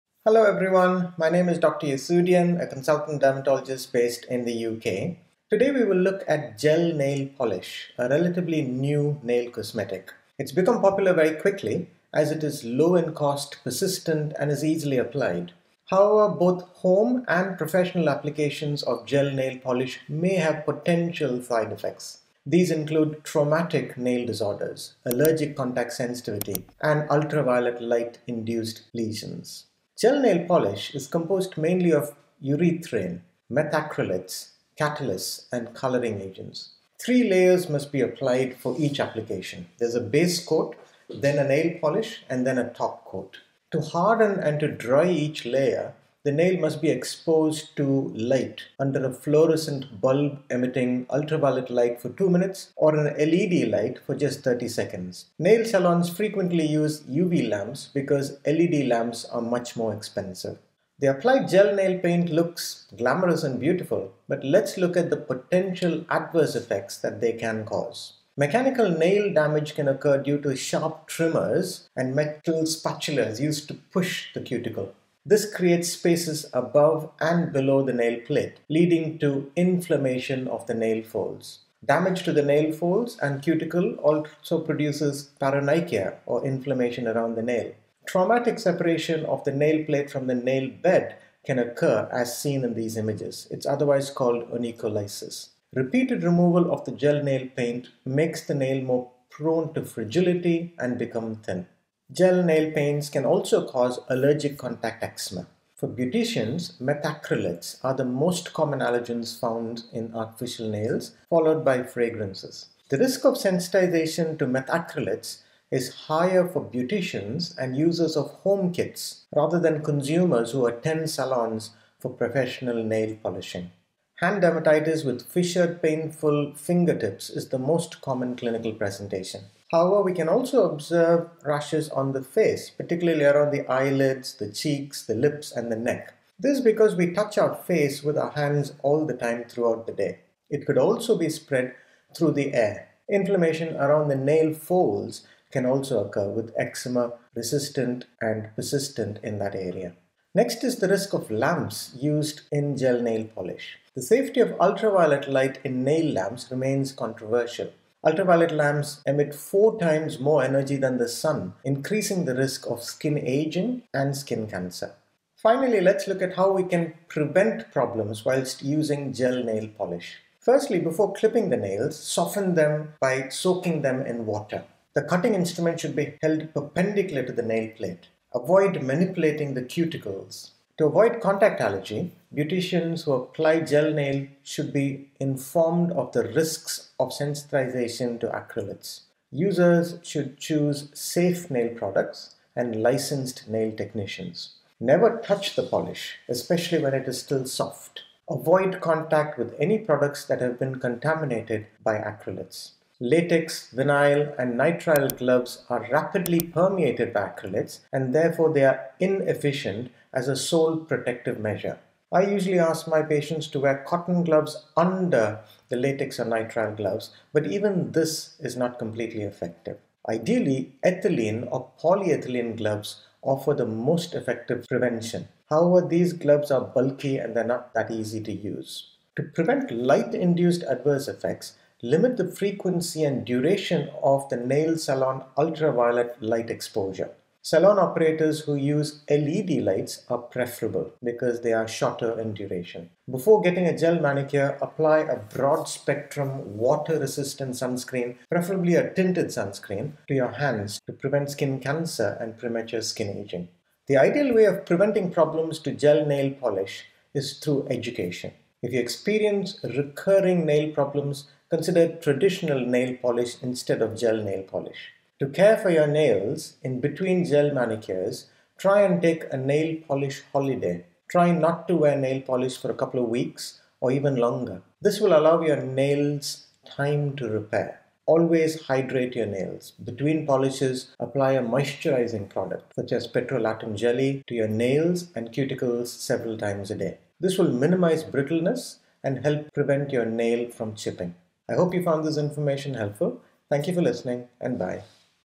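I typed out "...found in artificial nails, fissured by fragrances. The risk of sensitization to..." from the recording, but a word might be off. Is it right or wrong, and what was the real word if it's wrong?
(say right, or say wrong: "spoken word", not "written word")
wrong: "followed", not "fissured".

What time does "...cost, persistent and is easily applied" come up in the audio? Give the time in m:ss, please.
0:13.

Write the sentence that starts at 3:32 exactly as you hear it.
I usually ask my patients to wear cotton gloves under the latex or nitrile gloves, but even this is not completely effective.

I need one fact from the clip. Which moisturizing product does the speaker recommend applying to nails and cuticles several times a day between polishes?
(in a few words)
petrolatum jelly.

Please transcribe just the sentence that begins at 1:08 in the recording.
Mechanical nail damage can occur due to sharp trimmers and metal spatulas used to push the cuticle.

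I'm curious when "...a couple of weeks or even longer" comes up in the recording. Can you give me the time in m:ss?
4:32.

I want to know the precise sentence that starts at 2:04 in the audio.
Hand dermatitis with fissured, painful fingertips is the most common clinical presentation.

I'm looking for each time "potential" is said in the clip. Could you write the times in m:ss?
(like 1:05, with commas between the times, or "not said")
0:20, 1:05.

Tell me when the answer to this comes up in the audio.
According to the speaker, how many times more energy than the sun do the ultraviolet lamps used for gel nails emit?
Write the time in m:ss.
2:39.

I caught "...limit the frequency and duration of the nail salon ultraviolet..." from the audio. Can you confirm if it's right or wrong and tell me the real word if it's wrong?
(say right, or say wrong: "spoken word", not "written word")
right.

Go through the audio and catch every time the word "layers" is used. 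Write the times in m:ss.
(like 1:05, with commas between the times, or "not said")
0:37, 0:45.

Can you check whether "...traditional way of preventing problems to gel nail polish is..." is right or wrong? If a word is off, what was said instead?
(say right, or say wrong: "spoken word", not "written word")
wrong: "ideal", not "traditional".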